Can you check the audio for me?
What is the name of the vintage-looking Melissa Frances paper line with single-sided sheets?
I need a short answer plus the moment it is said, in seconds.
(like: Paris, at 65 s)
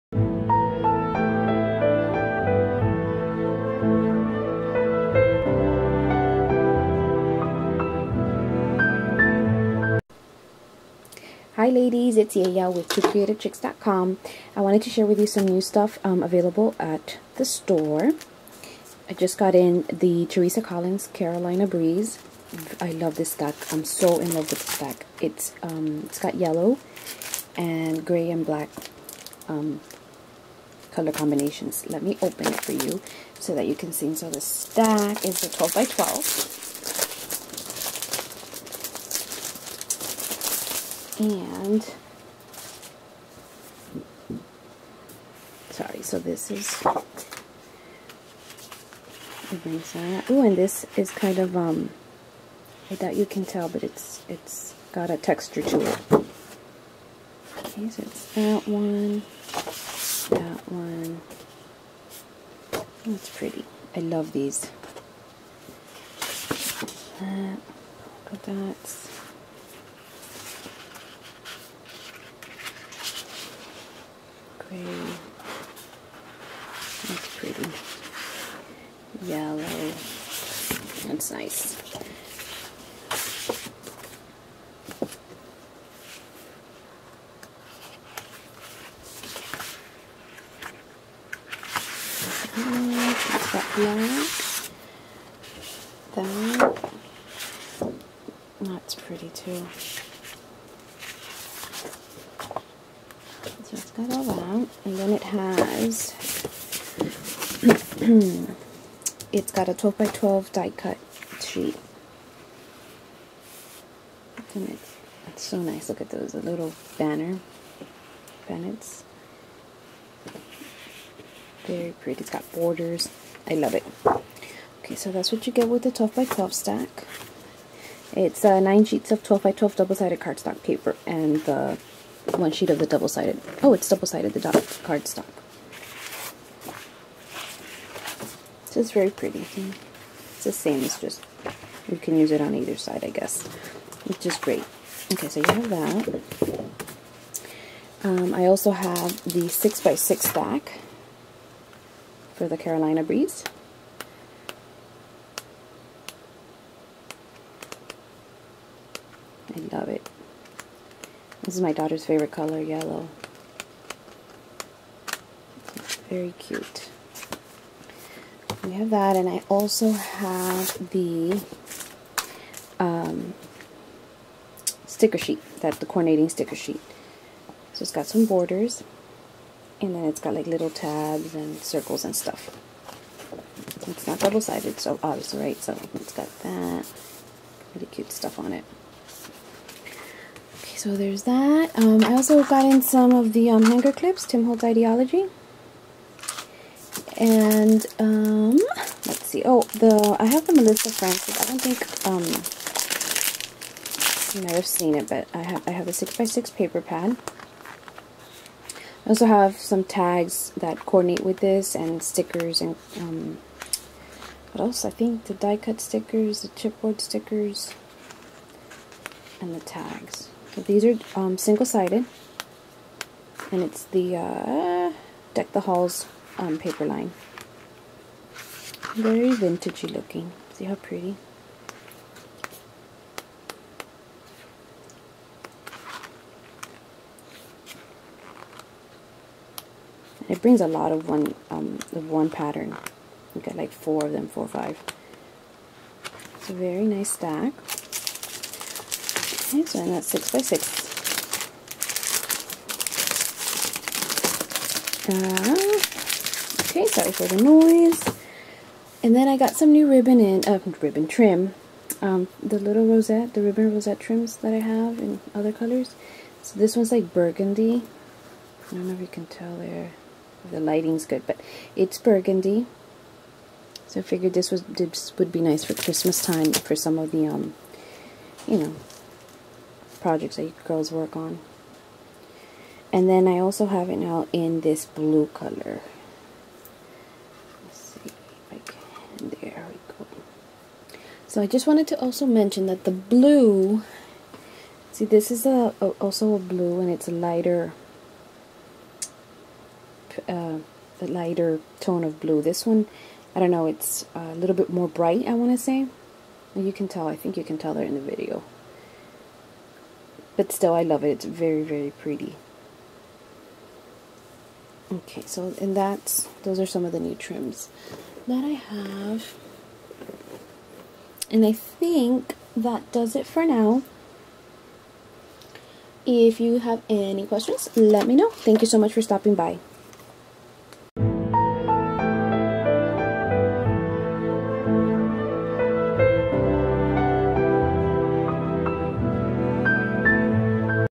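Deck the Halls, at 225 s.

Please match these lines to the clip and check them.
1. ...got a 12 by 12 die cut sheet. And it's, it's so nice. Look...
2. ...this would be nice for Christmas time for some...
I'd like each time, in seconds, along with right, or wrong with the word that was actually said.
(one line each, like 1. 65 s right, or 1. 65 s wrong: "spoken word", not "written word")
1. 109 s right
2. 274 s right.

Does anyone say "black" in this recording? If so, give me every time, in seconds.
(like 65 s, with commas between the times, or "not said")
28 s, 93 s.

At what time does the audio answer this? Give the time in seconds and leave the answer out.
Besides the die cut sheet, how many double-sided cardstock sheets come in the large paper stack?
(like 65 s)
128 s.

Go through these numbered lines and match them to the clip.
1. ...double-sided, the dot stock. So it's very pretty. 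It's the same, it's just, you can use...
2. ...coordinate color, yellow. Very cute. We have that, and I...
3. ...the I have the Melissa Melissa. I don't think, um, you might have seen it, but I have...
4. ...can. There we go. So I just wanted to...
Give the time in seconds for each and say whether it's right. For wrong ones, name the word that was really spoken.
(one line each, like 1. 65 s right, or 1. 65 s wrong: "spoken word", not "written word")
1. 133 s right
2. 162 s wrong: "favorite", not "coordinate"
3. 199 s wrong: "Frances", not "Melissa"
4. 288 s right.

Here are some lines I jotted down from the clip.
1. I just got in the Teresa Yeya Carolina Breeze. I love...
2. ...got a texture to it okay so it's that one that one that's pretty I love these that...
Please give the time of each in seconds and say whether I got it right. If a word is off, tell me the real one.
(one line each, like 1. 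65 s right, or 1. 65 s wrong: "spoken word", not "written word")
1. 19 s wrong: "Collins", not "Yeya"
2. 54 s right.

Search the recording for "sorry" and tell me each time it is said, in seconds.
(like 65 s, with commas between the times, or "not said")
45 s, 256 s.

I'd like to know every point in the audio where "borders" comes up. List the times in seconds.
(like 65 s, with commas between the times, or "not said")
122 s, 178 s.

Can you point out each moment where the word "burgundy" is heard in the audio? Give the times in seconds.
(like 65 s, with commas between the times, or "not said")
267 s, 271 s.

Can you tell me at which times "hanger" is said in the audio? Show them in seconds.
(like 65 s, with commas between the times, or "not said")
193 s.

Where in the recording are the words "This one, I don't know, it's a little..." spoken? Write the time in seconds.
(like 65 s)
302 s.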